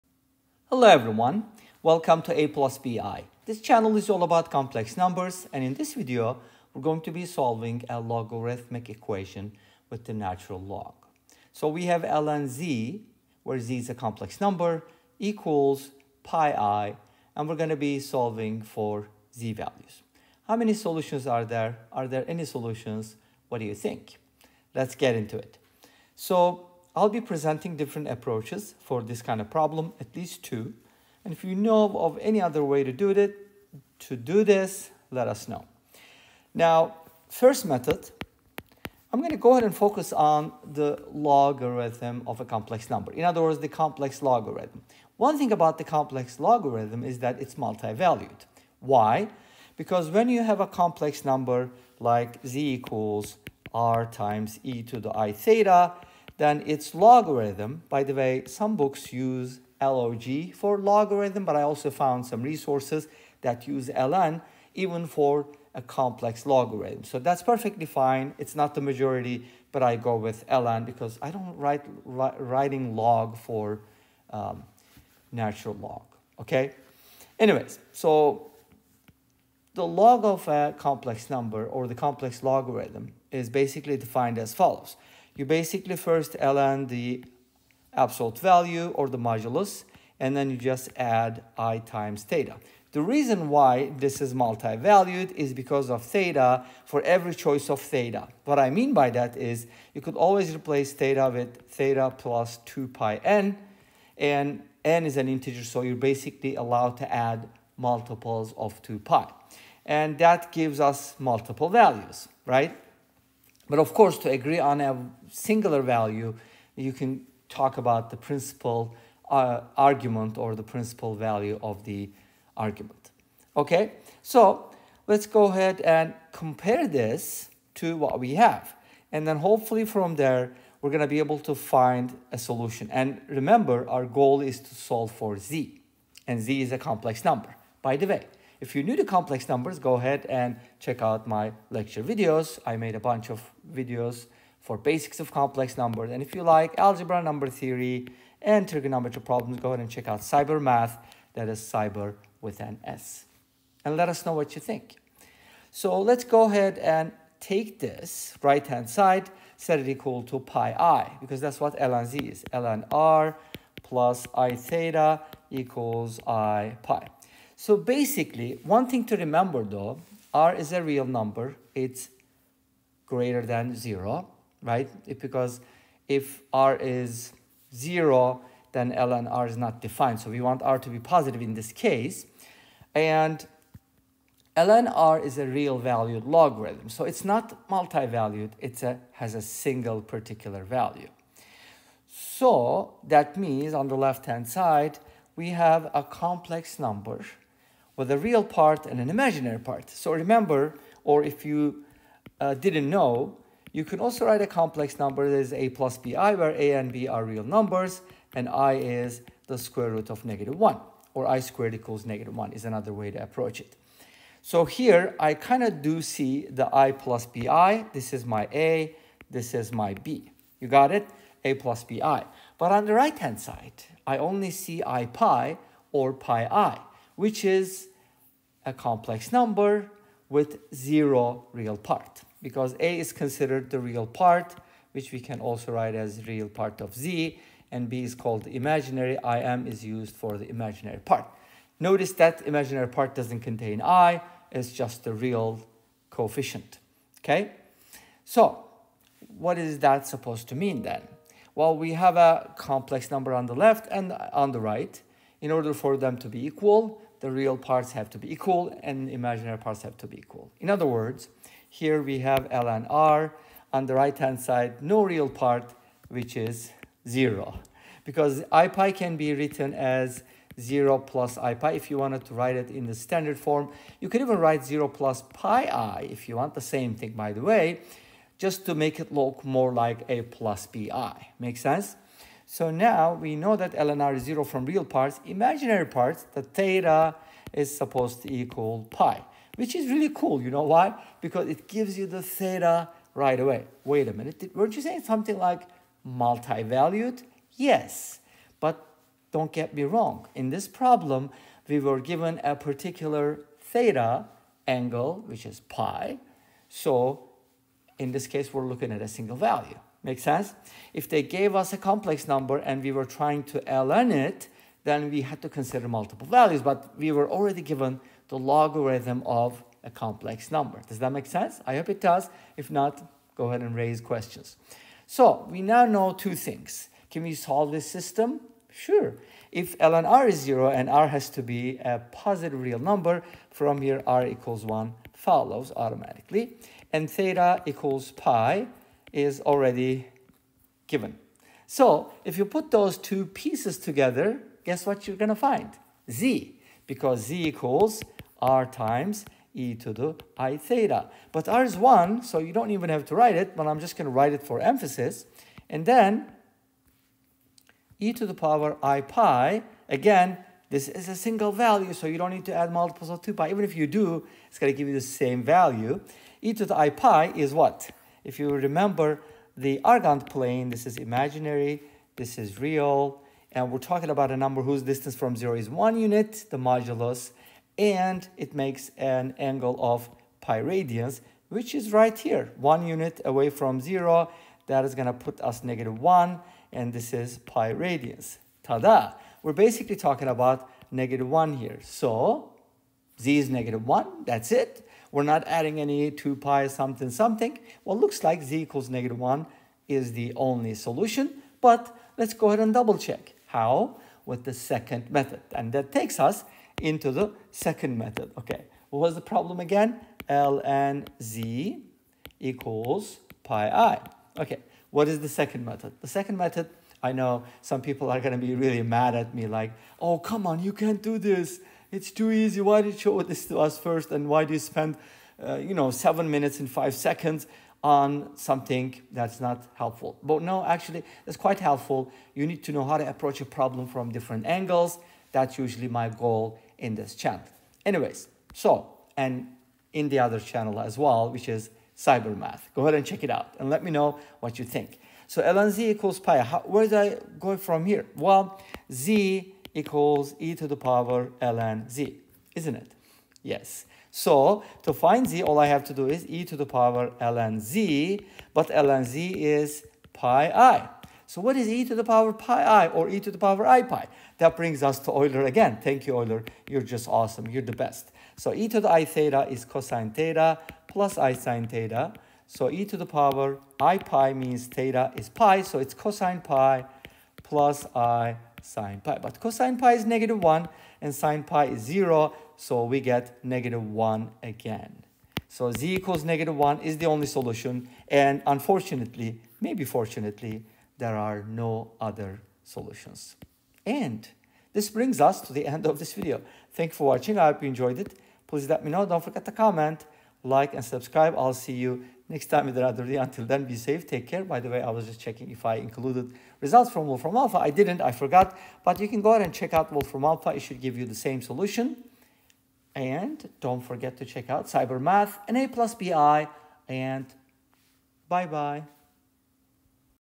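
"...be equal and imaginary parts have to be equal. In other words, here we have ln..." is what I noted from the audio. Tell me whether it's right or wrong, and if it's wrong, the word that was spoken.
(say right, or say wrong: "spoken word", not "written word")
right.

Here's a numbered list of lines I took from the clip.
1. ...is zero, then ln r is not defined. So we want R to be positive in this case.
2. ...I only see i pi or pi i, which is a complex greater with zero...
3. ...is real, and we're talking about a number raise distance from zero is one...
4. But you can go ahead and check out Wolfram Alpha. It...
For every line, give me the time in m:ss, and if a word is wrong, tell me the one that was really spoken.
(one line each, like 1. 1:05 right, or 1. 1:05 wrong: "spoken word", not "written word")
1. 2:56 right
2. 3:44 wrong: "number", not "greater"
3. 6:12 wrong: "whose", not "raise"
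4. 8:28 right.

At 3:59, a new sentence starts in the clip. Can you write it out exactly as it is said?
IM is used for the imaginary part.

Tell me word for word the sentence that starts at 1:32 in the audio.
The reason why this is multi-valued is because of theta for every choice of theta.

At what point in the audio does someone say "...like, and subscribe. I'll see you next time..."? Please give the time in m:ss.
8:20.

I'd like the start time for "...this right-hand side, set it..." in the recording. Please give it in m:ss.
2:37.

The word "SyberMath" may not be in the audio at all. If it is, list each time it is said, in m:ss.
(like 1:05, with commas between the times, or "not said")
2:30, 7:21, 8:34.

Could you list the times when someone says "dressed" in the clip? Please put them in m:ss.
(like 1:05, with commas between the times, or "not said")
not said.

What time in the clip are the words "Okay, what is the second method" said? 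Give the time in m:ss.
6:54.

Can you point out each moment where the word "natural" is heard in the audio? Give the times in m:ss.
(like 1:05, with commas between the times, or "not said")
0:10, 1:15.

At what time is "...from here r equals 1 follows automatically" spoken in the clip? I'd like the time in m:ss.
5:33.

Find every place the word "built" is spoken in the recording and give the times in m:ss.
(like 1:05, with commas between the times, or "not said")
not said.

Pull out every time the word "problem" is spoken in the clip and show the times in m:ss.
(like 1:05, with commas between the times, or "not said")
0:29, 2:29, 5:00, 6:49, 7:13.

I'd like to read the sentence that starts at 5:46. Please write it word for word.
Z, because Z equals R times e to the i theta.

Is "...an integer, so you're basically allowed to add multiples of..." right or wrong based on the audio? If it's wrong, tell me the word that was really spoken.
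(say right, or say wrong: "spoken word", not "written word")
right.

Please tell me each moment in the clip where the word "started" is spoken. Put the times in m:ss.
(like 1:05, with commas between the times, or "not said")
not said.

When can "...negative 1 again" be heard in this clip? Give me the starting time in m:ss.
8:03.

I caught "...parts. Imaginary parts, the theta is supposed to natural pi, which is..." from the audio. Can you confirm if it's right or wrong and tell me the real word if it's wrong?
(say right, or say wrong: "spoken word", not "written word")
wrong: "equal", not "natural".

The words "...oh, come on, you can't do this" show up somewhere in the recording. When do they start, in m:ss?
6:59.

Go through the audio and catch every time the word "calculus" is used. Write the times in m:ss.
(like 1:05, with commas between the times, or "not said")
not said.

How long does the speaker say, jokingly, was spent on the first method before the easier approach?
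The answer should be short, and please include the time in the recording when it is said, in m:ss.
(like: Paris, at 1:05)
7 minutes and 5 seconds, at 7:05.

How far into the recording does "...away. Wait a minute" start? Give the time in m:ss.
4:53.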